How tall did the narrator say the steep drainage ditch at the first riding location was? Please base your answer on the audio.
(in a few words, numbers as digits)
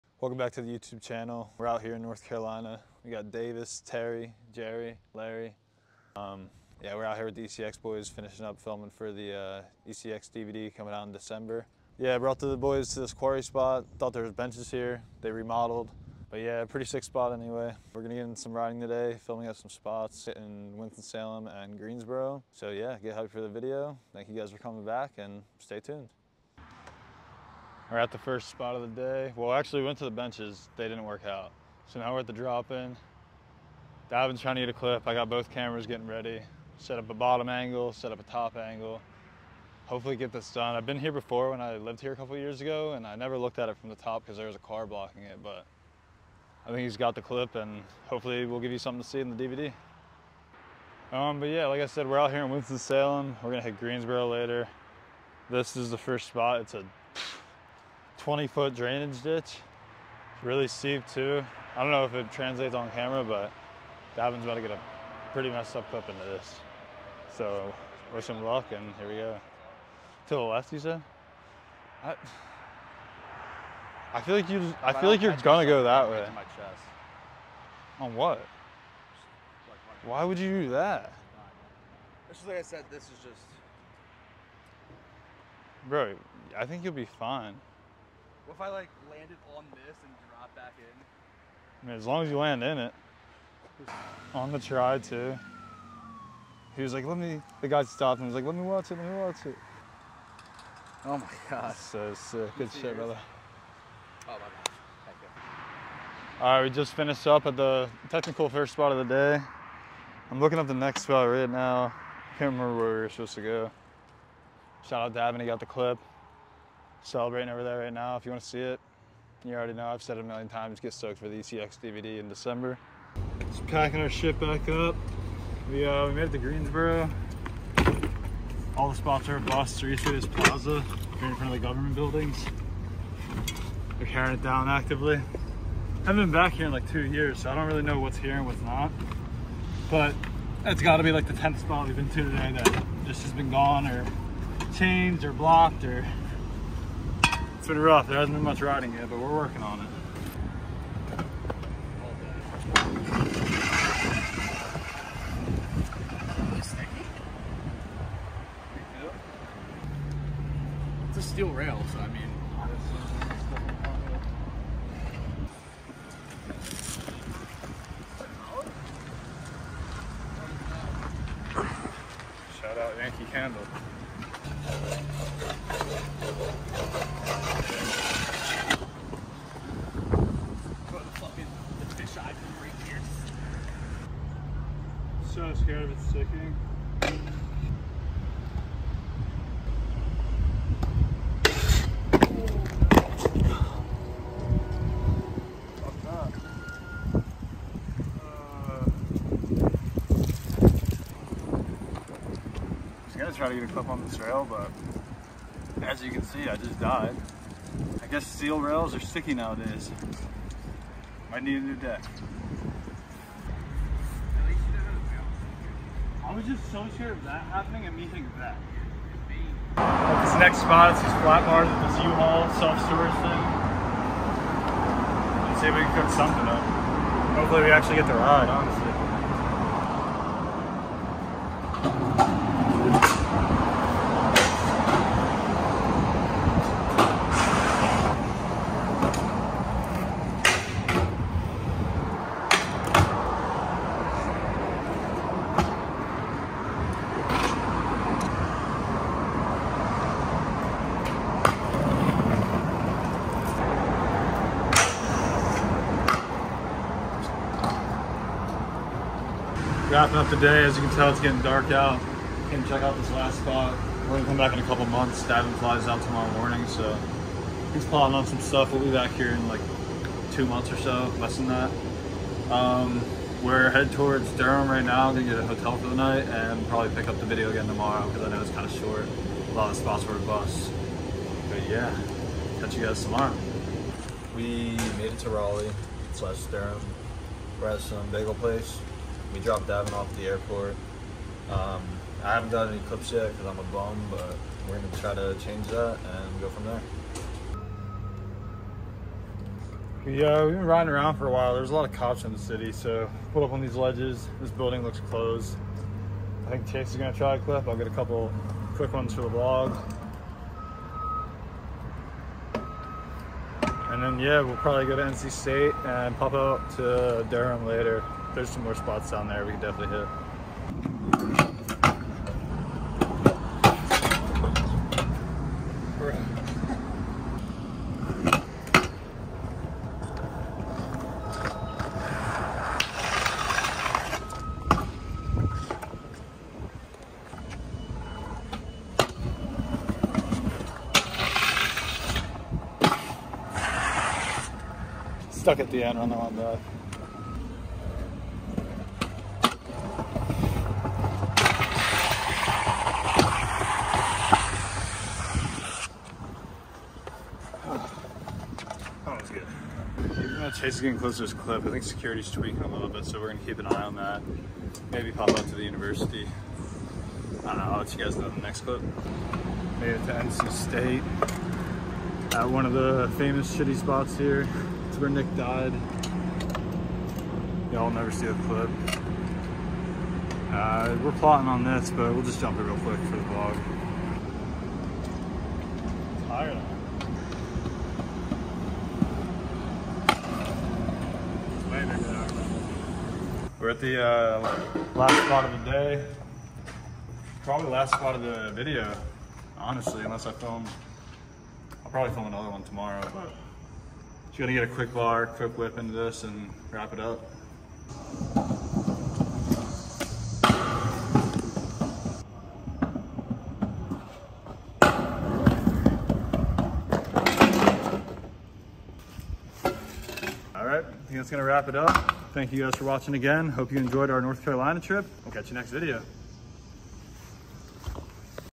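20 foot.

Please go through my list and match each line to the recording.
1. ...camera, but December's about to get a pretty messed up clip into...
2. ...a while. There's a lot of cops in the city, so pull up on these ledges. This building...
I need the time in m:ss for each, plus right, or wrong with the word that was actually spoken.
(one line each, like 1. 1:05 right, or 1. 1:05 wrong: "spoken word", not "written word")
1. 1:02 wrong: "Davin", not "December"
2. 5:01 right.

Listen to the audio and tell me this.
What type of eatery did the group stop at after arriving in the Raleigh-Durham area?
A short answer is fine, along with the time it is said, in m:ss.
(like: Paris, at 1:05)
bagel place, at 4:48.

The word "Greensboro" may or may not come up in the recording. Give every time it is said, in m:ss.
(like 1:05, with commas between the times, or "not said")
0:21, 0:53, 2:06.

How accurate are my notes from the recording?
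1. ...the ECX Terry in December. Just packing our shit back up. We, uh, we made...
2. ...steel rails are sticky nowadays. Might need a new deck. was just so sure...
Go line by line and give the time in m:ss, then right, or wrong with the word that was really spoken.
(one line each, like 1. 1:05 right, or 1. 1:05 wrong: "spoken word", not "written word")
1. 2:01 wrong: "DVD", not "Terry"
2. 3:28 right.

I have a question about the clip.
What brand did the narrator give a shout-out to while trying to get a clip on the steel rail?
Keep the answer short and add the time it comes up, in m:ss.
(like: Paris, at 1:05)
Yankee Candle, at 2:52.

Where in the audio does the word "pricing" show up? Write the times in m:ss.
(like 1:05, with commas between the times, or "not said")
not said.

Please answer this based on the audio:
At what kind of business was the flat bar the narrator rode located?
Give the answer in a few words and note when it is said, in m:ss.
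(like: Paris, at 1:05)
U-Haul self-storage, at 3:42.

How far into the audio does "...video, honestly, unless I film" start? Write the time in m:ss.
6:38.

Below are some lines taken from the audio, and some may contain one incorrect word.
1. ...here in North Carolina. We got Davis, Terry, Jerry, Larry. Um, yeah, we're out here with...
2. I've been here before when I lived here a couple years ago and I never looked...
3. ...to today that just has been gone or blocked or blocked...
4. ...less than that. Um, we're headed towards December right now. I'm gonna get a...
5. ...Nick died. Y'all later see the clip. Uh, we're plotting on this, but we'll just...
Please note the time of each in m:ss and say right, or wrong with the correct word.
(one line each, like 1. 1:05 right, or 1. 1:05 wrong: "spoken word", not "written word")
1. 0:01 right
2. 0:40 right
3. 2:22 wrong: "changed", not "blocked"
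4. 4:31 wrong: "Durham", not "December"
5. 6:15 wrong: "never", not "later".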